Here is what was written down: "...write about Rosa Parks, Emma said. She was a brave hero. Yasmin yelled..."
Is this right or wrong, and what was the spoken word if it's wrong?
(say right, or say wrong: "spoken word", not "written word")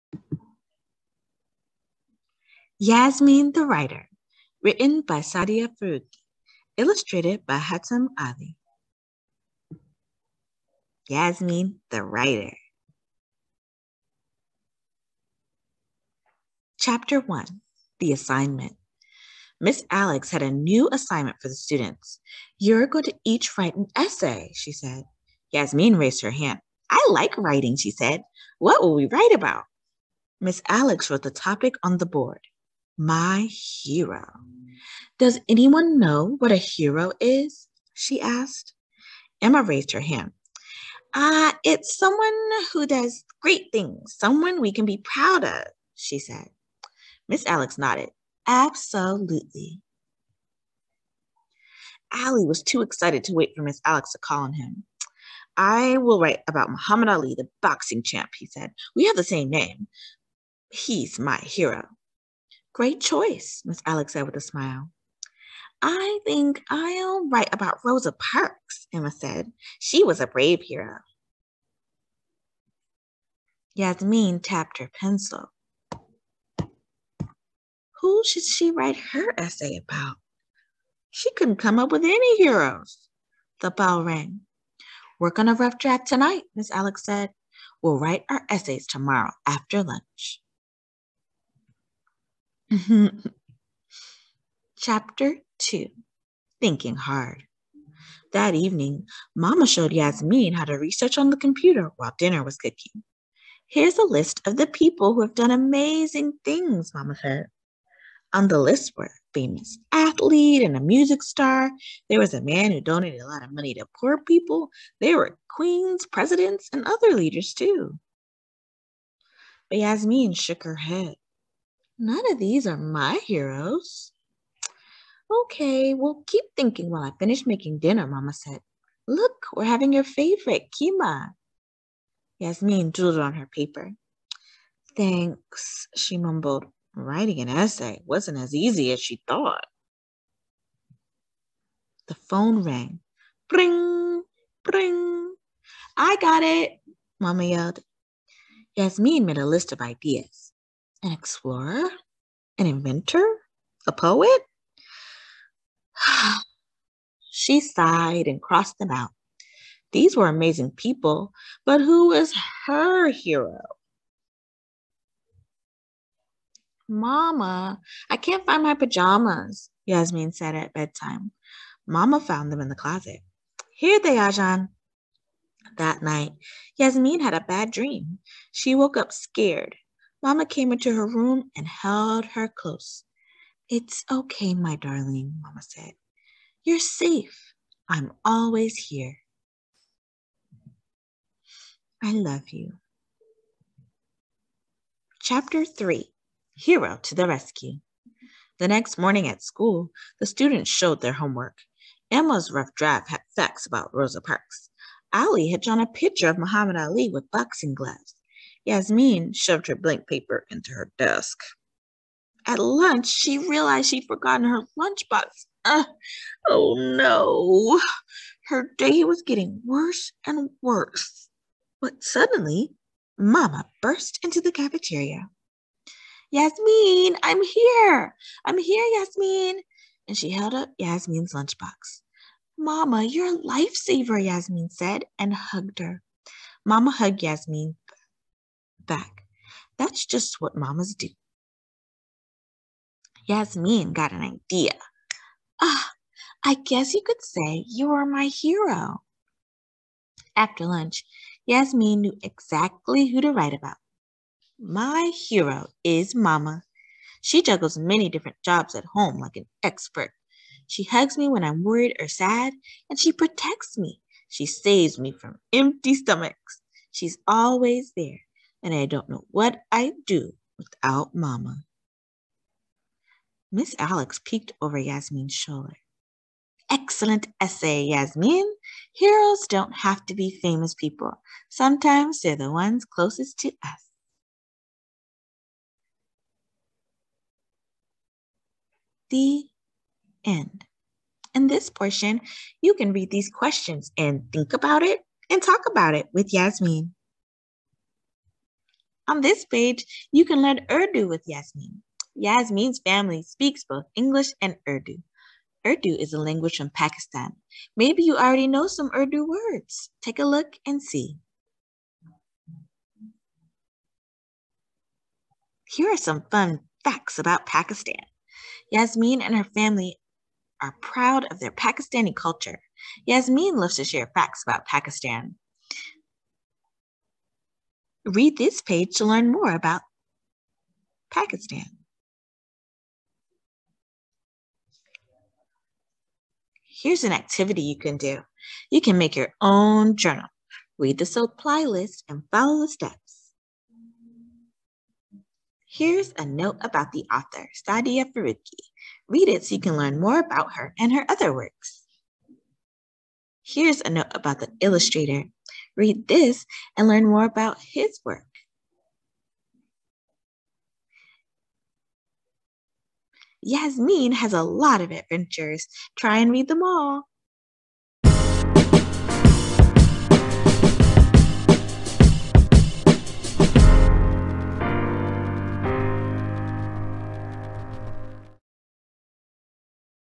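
wrong: "tapped", not "yelled".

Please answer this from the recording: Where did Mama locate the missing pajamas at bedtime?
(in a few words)
In the closet.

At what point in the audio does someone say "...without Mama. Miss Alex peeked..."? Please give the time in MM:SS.
04:30.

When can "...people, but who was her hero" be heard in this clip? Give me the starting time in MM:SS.
02:40.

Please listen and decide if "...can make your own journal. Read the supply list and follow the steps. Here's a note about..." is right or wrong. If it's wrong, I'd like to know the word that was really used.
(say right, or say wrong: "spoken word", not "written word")
right.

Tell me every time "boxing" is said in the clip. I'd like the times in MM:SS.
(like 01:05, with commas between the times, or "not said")
00:57, 03:27.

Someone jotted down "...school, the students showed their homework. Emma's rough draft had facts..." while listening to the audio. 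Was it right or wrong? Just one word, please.
right.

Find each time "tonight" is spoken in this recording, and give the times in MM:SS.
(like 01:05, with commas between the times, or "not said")
01:26.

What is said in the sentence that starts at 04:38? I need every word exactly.
Heroes don't have to be famous people.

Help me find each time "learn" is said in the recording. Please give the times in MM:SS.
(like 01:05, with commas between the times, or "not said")
05:00, 05:29, 05:49, 05:56.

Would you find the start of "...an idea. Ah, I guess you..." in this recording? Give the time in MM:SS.
04:04.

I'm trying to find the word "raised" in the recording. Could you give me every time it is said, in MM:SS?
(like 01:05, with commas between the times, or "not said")
00:25, 00:39.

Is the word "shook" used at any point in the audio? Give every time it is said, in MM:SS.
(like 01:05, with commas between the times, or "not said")
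02:00.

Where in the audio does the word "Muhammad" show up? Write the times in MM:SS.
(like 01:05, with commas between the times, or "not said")
00:56, 03:26.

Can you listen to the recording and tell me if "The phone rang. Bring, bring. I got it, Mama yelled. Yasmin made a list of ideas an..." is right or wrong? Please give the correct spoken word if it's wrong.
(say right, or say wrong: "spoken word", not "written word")
right.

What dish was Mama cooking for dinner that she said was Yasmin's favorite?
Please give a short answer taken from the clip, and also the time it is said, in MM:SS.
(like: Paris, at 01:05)
Keema, at 02:10.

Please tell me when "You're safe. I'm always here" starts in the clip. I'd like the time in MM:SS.
03:06.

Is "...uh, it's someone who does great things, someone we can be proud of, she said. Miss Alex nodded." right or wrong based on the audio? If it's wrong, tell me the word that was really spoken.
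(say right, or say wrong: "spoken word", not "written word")
right.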